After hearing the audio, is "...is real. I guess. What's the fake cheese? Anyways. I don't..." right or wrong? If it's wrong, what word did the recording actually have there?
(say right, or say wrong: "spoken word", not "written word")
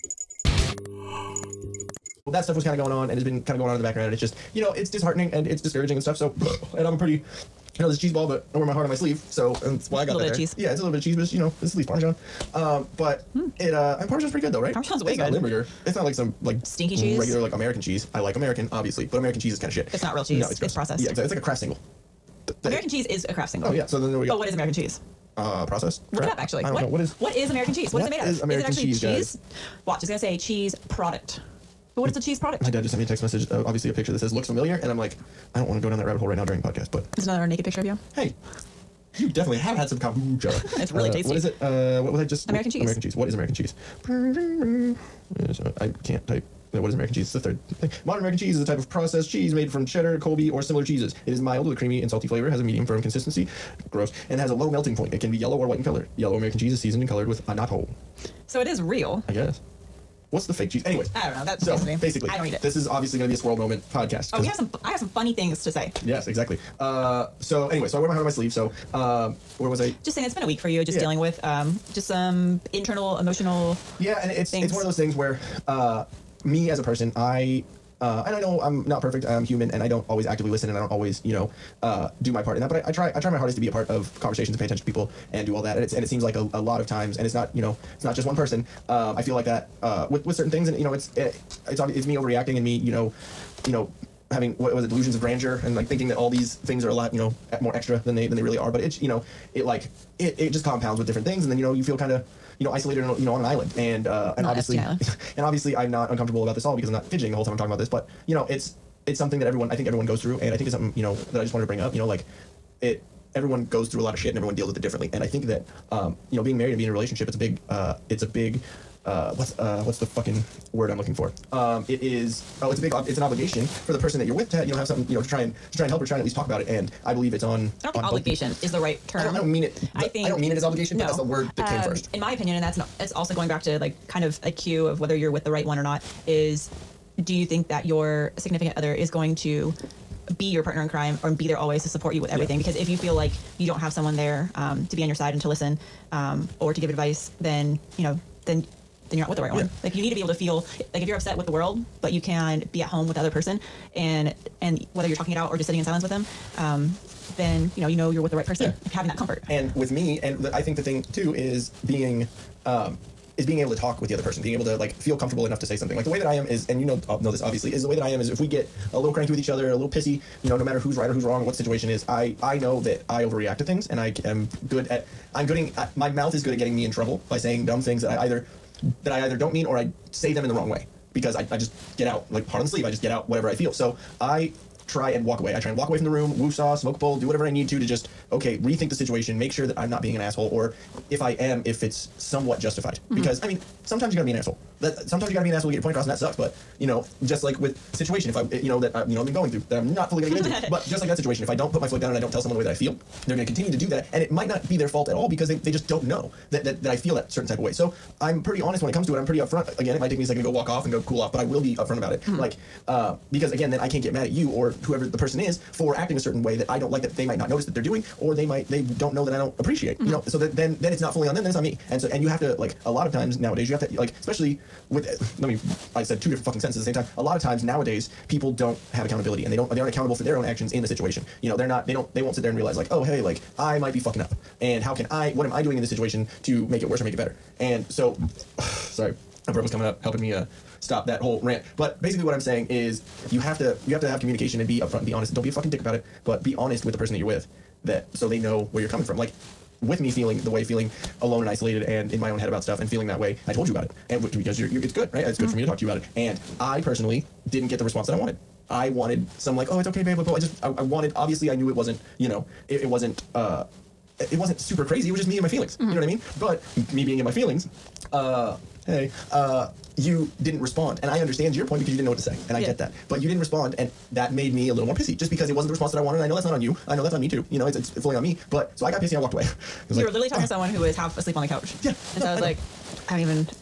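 right.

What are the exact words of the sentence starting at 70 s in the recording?
dealing with um, just some internal emotional.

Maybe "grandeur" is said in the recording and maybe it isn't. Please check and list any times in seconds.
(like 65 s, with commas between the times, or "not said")
95 s.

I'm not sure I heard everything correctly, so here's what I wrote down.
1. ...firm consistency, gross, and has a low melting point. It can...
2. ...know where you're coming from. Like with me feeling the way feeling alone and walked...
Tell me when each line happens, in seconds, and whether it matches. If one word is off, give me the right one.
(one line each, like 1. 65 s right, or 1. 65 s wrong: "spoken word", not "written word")
1. 52 s right
2. 248 s wrong: "isolated", not "walked".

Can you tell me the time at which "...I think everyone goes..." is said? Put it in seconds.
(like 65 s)
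109 s.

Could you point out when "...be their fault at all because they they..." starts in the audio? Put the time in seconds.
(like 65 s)
204 s.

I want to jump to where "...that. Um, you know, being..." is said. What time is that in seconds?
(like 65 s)
115 s.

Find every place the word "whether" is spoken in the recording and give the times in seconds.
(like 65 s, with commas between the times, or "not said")
134 s, 154 s.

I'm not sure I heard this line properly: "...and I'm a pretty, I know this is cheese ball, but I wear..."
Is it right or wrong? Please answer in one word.
right.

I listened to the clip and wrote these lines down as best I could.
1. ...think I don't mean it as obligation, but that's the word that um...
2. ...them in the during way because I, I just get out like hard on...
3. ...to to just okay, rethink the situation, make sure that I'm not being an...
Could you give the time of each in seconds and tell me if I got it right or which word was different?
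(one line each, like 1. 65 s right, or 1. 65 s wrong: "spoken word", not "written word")
1. 130 s right
2. 180 s wrong: "wrong", not "during"
3. 187 s right.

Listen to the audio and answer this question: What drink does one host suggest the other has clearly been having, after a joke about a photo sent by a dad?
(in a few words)
kombucha.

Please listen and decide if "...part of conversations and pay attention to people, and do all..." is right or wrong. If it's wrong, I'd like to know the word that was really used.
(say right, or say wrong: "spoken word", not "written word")
right.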